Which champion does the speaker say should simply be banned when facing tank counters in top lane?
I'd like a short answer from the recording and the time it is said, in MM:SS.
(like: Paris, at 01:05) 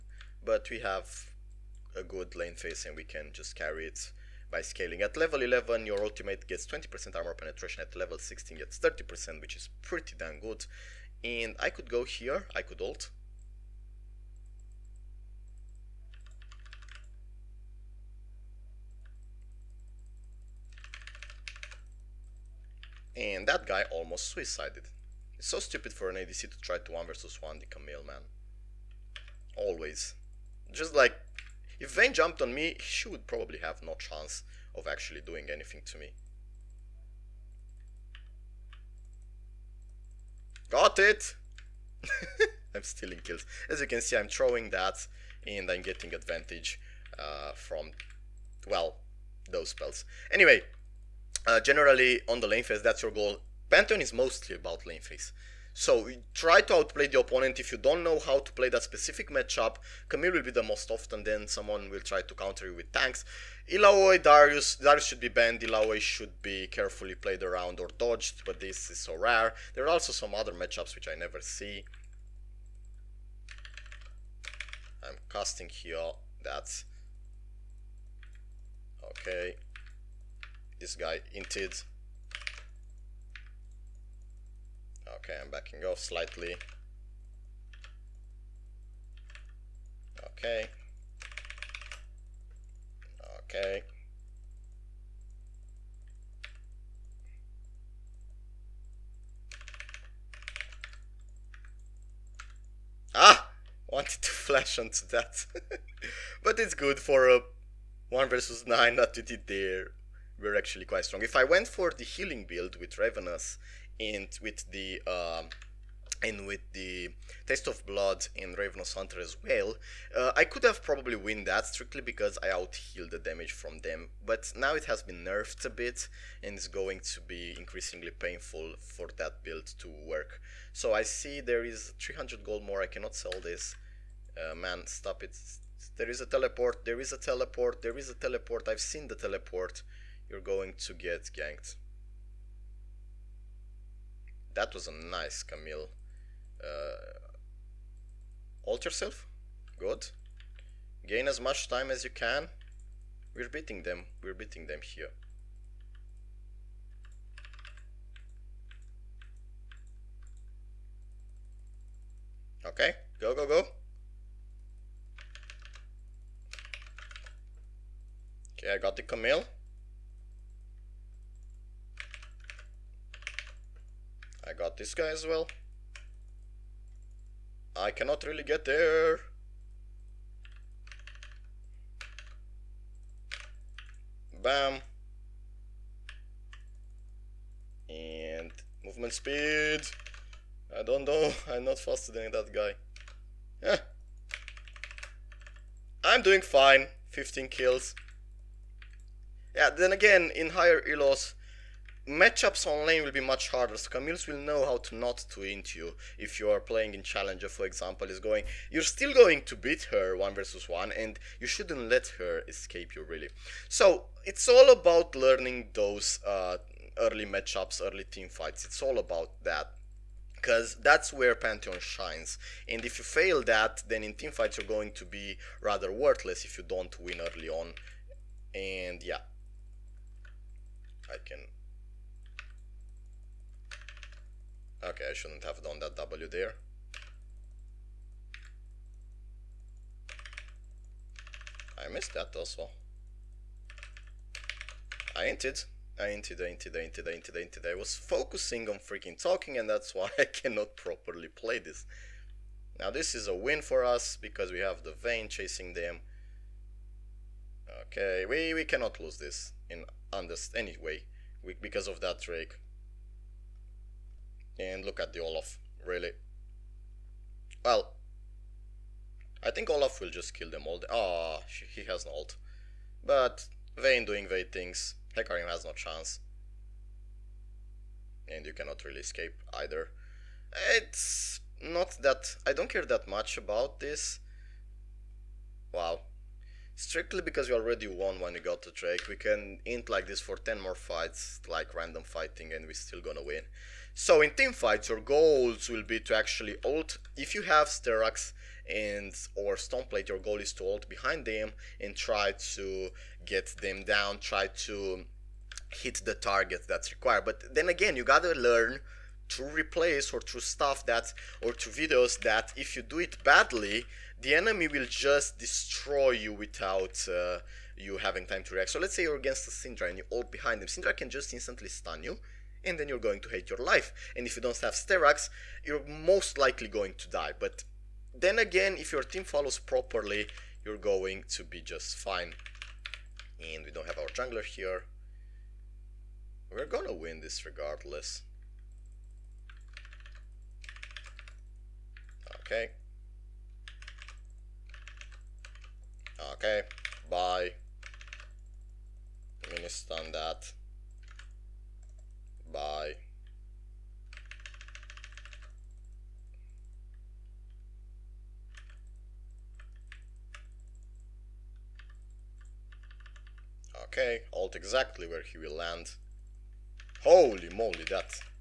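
Darius, at 01:04.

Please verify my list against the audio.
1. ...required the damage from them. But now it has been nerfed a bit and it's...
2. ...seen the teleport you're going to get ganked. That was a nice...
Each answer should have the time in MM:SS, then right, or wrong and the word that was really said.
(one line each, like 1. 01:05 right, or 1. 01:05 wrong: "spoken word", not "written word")
1. 02:02 wrong: "outhealed", not "required"
2. 02:18 right.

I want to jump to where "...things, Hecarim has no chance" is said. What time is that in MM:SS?
04:34.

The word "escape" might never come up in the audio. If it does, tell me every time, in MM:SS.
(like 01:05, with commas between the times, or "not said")
03:32, 04:39.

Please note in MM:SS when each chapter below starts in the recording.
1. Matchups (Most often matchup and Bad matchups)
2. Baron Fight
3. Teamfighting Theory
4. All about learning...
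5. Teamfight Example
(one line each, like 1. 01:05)
1. 00:48
2. 05:23
3. 04:58
4. 03:23
5. 02:38.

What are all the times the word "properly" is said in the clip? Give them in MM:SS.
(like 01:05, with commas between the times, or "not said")
04:10, 05:29.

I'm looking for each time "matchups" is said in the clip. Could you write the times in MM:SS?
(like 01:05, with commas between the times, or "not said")
00:59, 01:10, 03:22, 03:37.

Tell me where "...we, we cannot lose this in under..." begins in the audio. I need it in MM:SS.
04:18.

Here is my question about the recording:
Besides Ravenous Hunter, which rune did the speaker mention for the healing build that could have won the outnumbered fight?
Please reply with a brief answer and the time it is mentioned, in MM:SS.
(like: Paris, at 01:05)
Taste of Blood, at 01:57.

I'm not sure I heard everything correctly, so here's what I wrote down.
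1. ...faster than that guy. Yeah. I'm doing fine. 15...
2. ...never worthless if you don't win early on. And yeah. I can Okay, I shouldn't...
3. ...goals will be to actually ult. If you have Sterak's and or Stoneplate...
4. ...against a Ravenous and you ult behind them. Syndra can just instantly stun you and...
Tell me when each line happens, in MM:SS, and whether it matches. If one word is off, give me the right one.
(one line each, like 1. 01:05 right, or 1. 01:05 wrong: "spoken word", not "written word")
1. 03:11 right
2. 03:45 wrong: "rather", not "never"
3. 04:55 right
4. 05:19 wrong: "Syndra", not "Ravenous".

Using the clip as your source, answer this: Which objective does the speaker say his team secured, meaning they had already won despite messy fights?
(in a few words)
Drake.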